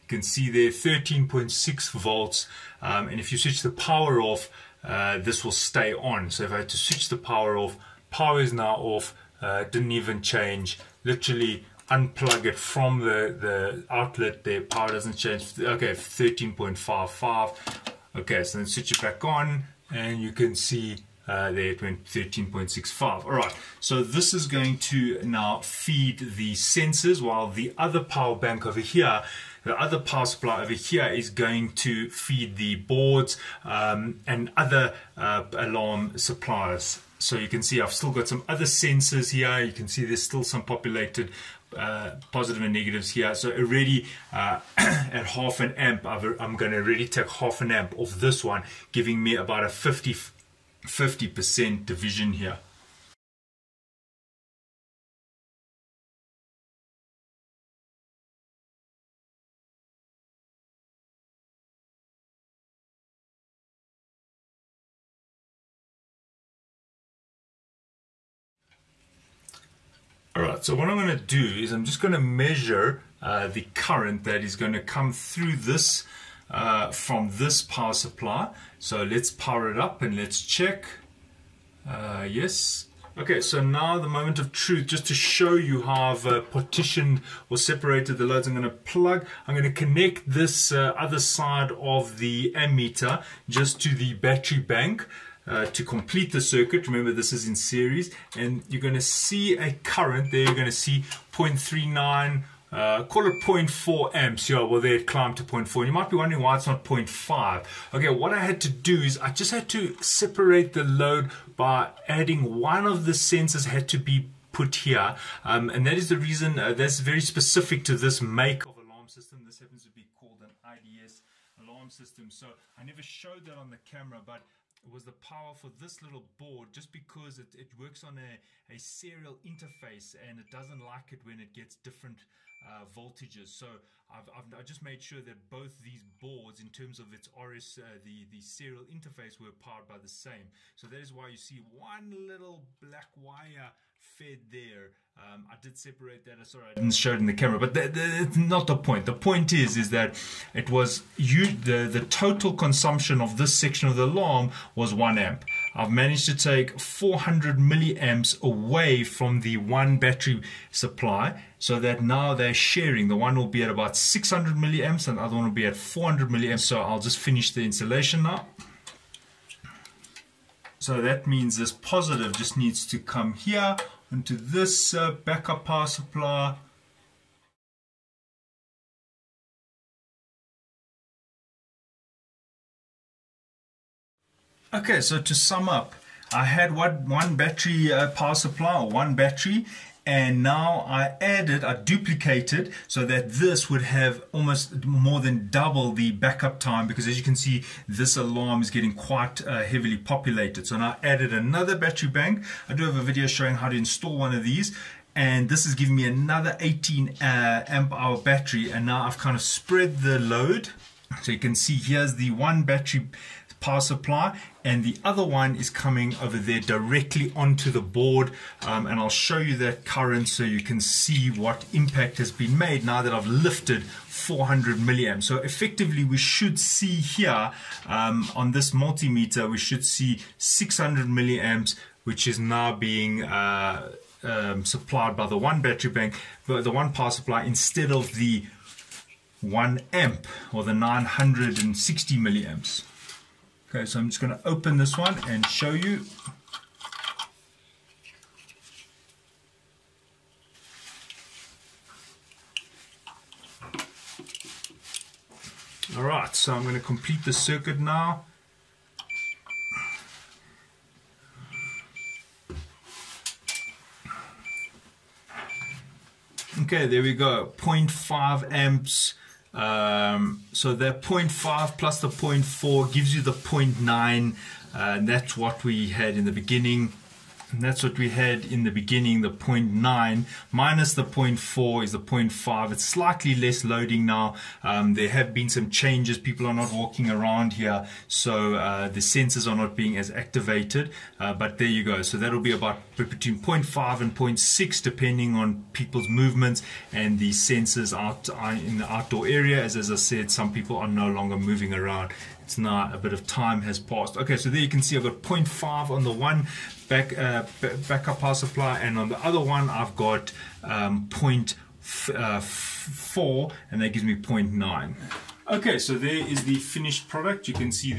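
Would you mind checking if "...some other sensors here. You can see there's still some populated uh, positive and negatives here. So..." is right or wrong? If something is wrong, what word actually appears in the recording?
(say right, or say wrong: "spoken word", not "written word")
right.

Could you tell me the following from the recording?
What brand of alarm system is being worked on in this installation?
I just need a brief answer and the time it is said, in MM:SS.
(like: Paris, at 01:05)
IDS, at 02:00.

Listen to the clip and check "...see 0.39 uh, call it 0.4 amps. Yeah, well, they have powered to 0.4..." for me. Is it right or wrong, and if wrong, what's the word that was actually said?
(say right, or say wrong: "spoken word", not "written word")
wrong: "climbed", not "powered".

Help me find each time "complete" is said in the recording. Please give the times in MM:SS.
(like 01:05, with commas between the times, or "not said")
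01:35, 04:16.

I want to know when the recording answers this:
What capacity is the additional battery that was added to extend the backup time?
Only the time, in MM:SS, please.
03:26.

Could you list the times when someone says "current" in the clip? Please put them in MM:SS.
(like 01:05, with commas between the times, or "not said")
01:13, 01:39, 03:39.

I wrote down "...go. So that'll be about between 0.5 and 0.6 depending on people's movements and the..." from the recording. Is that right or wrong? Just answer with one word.
right.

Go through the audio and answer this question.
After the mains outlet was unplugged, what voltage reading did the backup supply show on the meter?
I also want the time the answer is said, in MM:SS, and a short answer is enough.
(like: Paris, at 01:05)
13.55 volts, at 00:15.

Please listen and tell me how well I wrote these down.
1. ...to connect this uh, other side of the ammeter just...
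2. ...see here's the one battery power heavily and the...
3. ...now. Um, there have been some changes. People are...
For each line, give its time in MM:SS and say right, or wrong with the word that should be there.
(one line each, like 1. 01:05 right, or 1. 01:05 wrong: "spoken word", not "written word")
1. 01:29 right
2. 03:31 wrong: "supply", not "heavily"
3. 04:44 right.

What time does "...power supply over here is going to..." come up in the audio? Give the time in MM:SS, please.
00:29.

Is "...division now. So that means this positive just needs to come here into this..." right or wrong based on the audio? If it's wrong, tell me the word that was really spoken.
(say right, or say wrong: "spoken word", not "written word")
wrong: "installation", not "division".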